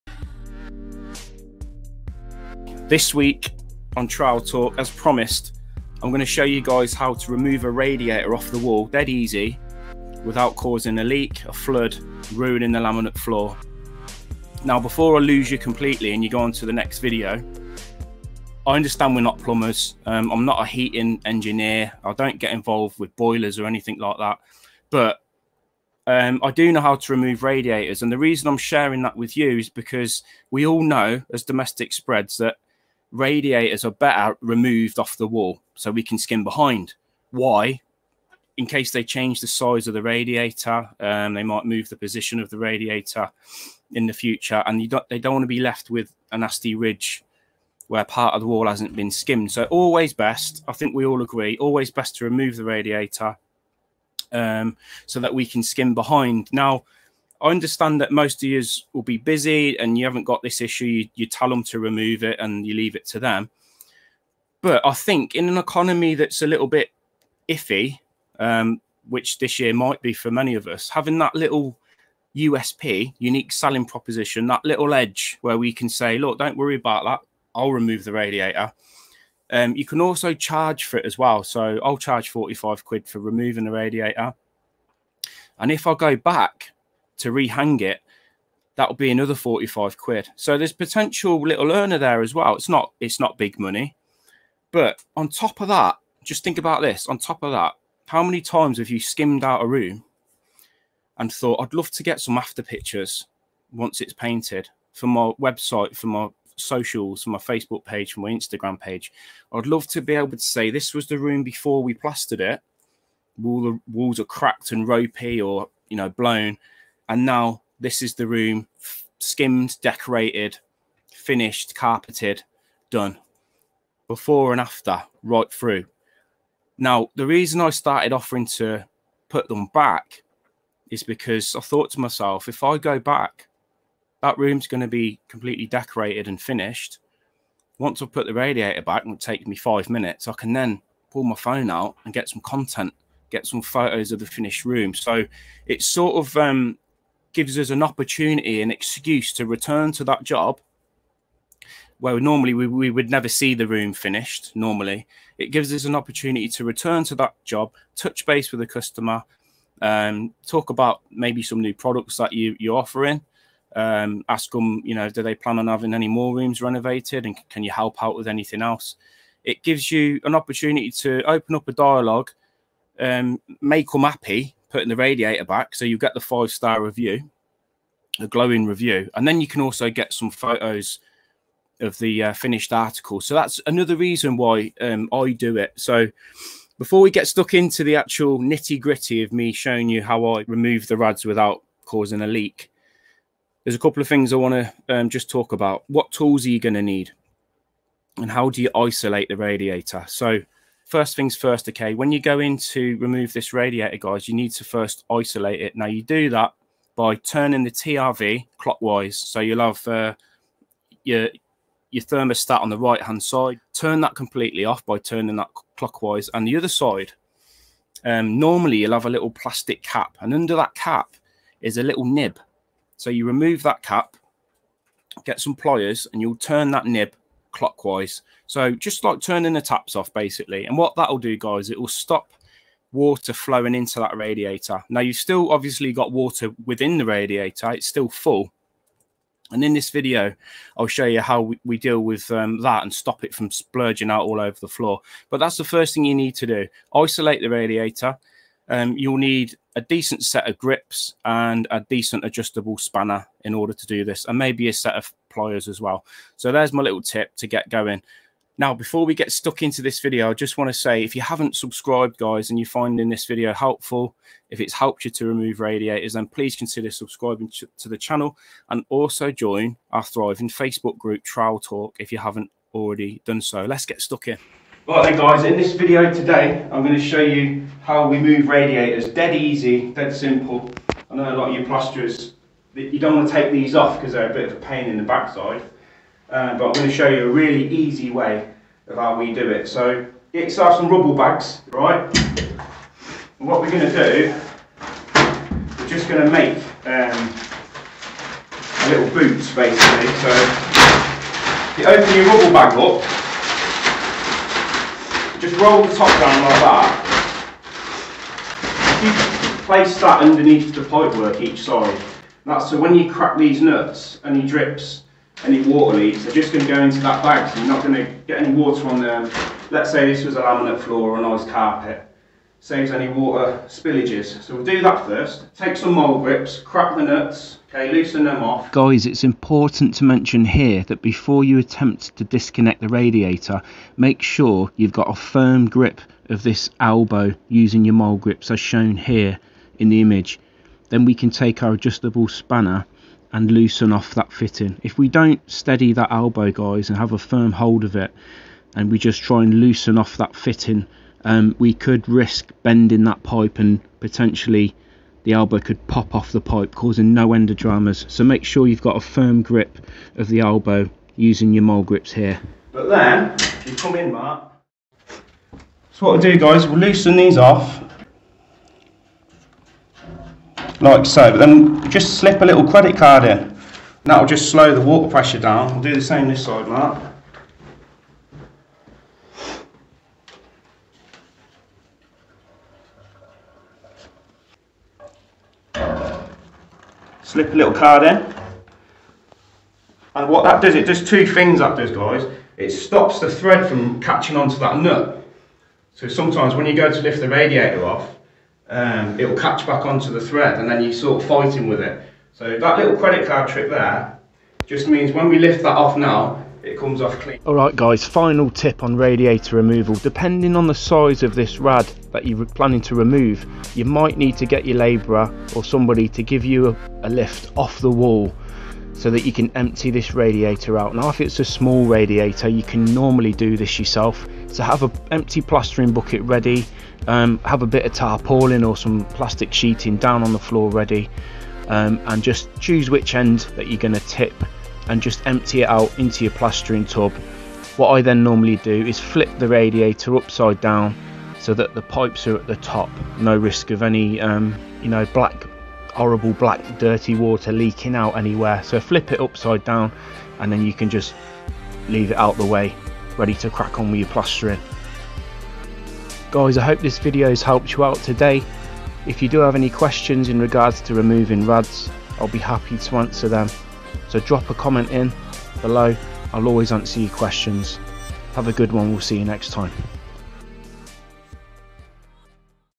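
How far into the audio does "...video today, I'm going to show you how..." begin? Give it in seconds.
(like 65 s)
275 s.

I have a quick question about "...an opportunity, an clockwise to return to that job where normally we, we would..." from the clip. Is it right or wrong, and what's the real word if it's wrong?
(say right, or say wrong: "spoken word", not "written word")
wrong: "excuse", not "clockwise".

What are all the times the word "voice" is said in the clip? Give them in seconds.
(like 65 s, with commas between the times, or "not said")
not said.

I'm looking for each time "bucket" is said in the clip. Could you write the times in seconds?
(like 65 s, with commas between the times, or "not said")
425 s.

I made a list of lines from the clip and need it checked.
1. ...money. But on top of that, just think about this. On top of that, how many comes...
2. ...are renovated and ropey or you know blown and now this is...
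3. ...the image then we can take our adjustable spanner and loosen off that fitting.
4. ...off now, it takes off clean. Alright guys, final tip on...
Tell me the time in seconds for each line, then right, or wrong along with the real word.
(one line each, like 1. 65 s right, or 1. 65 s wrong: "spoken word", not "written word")
1. 93 s wrong: "times", not "comes"
2. 114 s wrong: "cracked", not "renovated"
3. 339 s right
4. 405 s wrong: "comes", not "takes".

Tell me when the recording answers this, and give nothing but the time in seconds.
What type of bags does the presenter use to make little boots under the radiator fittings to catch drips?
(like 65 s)
290 s.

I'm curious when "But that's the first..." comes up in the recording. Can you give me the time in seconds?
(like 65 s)
245 s.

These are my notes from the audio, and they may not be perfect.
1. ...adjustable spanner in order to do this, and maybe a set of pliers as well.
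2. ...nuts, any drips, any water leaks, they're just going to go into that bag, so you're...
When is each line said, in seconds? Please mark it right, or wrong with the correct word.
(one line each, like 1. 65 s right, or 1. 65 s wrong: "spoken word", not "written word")
1. 252 s right
2. 313 s right.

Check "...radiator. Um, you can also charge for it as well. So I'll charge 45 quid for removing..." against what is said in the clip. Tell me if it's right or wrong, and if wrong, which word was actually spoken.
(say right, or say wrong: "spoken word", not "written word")
right.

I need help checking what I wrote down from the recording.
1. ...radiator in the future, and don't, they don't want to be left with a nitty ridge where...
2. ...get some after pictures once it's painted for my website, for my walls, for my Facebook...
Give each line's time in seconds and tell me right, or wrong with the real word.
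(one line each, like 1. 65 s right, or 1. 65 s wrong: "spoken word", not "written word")
1. 42 s wrong: "nasty", not "nitty"
2. 102 s wrong: "socials", not "walls".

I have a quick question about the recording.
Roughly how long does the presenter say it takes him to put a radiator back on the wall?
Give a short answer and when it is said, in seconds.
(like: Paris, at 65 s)
5 minutes, at 139 s.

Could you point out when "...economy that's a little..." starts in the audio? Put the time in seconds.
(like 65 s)
65 s.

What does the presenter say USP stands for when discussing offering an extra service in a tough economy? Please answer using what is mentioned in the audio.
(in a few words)
Unique selling proposition.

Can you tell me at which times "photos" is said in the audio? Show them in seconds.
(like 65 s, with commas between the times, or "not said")
143 s, 180 s.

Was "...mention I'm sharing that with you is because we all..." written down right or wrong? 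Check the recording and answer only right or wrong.
wrong.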